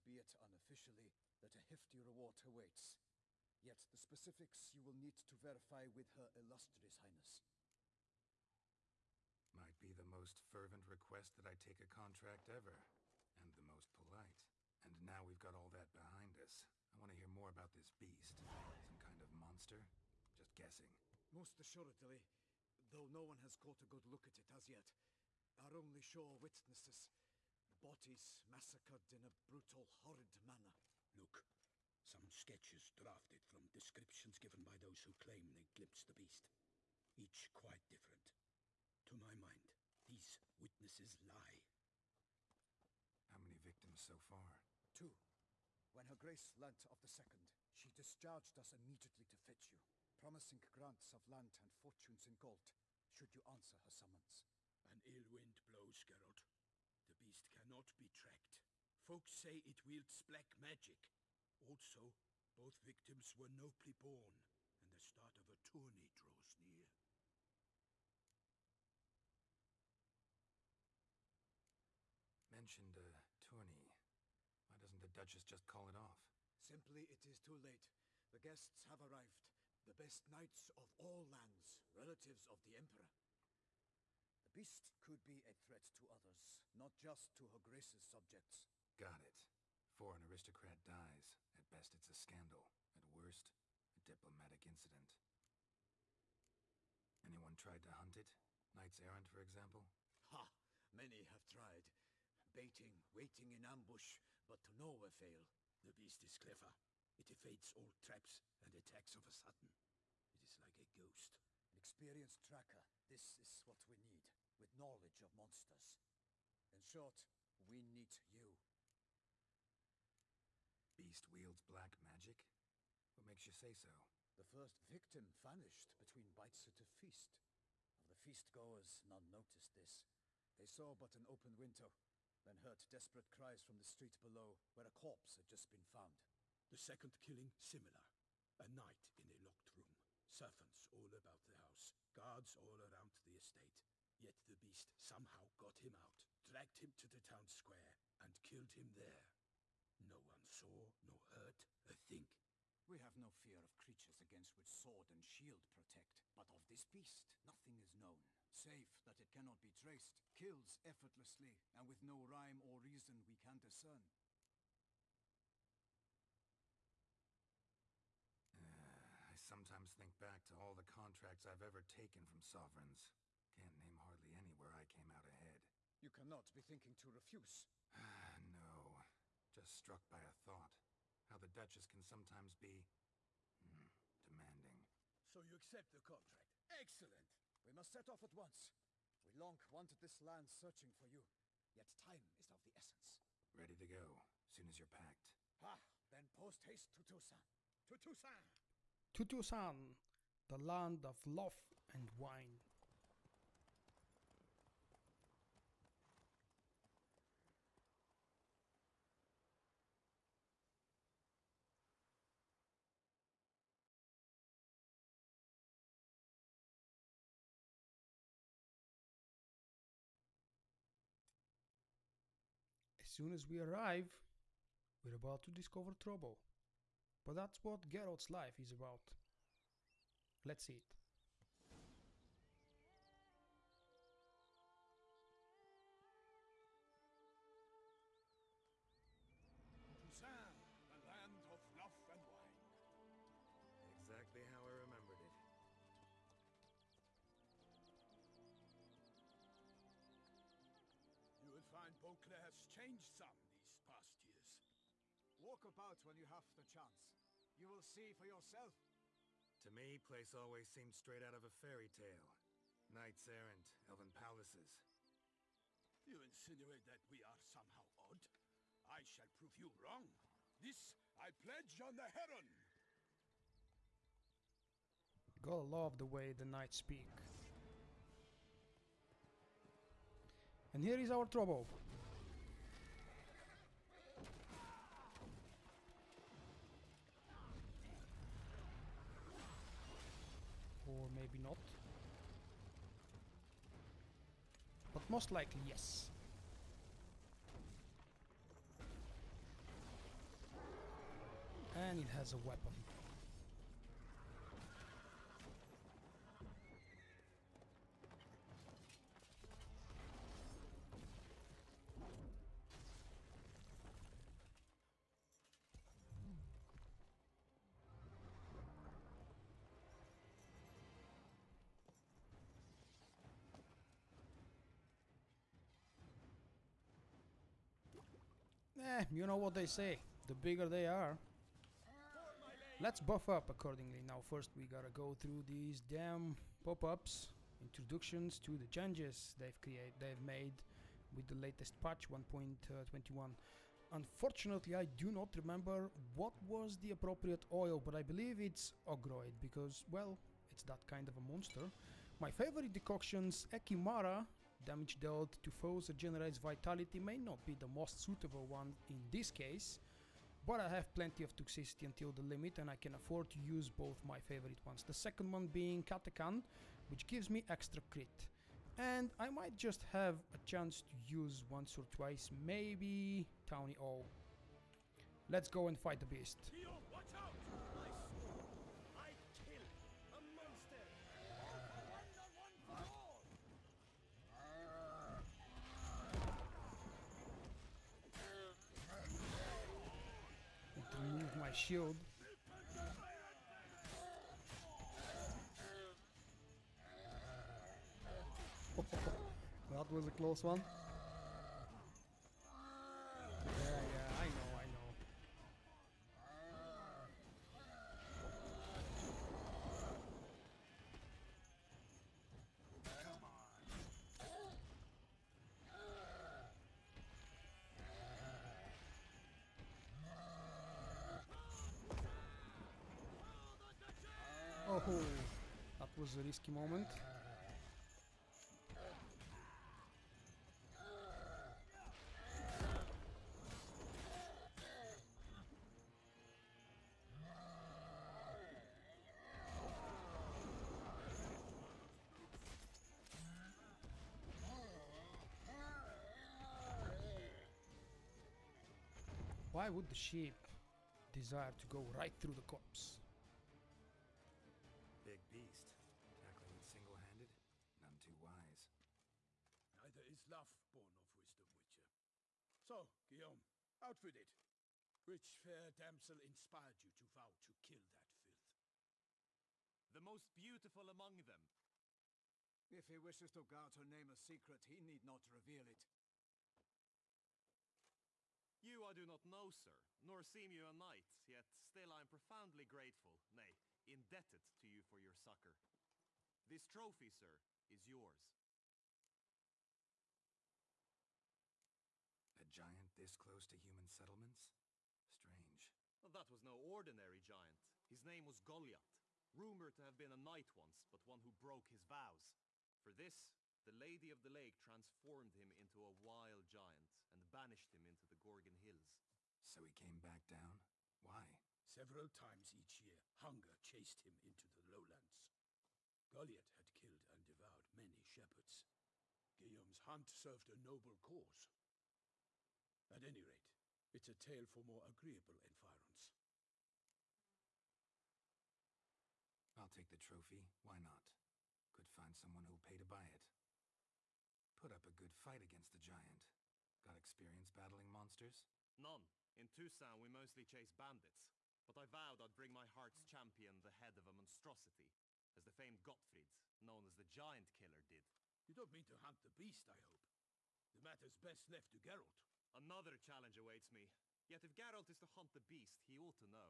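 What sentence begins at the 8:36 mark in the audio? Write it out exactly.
Goliath had killed and devoured many shepherds.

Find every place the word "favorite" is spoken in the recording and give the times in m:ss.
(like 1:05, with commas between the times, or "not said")
5:52, 6:04.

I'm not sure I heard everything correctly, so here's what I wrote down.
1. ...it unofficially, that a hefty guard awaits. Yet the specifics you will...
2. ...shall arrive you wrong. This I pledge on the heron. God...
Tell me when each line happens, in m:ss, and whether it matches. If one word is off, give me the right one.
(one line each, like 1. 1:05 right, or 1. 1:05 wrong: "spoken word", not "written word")
1. 0:00 wrong: "reward", not "guard"
2. 4:29 wrong: "prove", not "arrive".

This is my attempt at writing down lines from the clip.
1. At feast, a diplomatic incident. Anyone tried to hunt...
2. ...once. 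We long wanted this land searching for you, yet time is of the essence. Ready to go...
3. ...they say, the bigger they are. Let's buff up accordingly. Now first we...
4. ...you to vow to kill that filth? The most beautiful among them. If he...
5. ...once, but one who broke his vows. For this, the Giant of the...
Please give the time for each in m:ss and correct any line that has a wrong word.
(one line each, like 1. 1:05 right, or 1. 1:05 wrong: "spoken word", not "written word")
1. 1:32 wrong: "worst", not "feast"
2. 3:08 right
3. 5:29 right
4. 7:46 right
5. 8:20 wrong: "Lady", not "Giant".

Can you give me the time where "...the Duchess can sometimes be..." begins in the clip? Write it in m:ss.
3:01.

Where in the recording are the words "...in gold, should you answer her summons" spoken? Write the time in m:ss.
0:52.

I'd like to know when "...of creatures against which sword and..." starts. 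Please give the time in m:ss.
2:33.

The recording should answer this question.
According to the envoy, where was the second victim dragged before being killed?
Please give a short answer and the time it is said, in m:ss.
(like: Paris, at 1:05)
The town square, at 2:27.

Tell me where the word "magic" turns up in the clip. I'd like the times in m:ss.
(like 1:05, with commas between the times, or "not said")
1:00, 2:02.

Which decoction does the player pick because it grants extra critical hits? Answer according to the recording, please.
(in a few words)
Katakan.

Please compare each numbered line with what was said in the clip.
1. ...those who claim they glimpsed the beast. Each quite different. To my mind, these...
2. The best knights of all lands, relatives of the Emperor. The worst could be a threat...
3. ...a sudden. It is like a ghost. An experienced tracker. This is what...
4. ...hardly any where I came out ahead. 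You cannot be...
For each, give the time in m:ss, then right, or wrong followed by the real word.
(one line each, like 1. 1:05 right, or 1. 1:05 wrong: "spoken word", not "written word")
1. 0:34 right
2. 1:19 wrong: "beast", not "worst"
3. 1:49 right
4. 2:54 right.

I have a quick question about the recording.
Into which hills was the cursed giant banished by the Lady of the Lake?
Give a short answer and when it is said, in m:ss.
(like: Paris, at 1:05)
The Gorgon Hills, at 8:28.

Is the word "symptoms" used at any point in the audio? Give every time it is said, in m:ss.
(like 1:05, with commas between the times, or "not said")
not said.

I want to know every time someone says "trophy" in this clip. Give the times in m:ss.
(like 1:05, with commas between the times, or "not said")
8:06, 8:49.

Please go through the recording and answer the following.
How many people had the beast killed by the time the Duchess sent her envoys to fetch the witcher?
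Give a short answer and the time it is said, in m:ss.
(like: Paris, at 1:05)
2, at 0:44.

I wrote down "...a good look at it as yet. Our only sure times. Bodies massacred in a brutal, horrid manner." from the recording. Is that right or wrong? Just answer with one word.
wrong.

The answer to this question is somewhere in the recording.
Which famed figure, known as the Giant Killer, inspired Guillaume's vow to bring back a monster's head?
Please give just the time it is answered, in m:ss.
9:05.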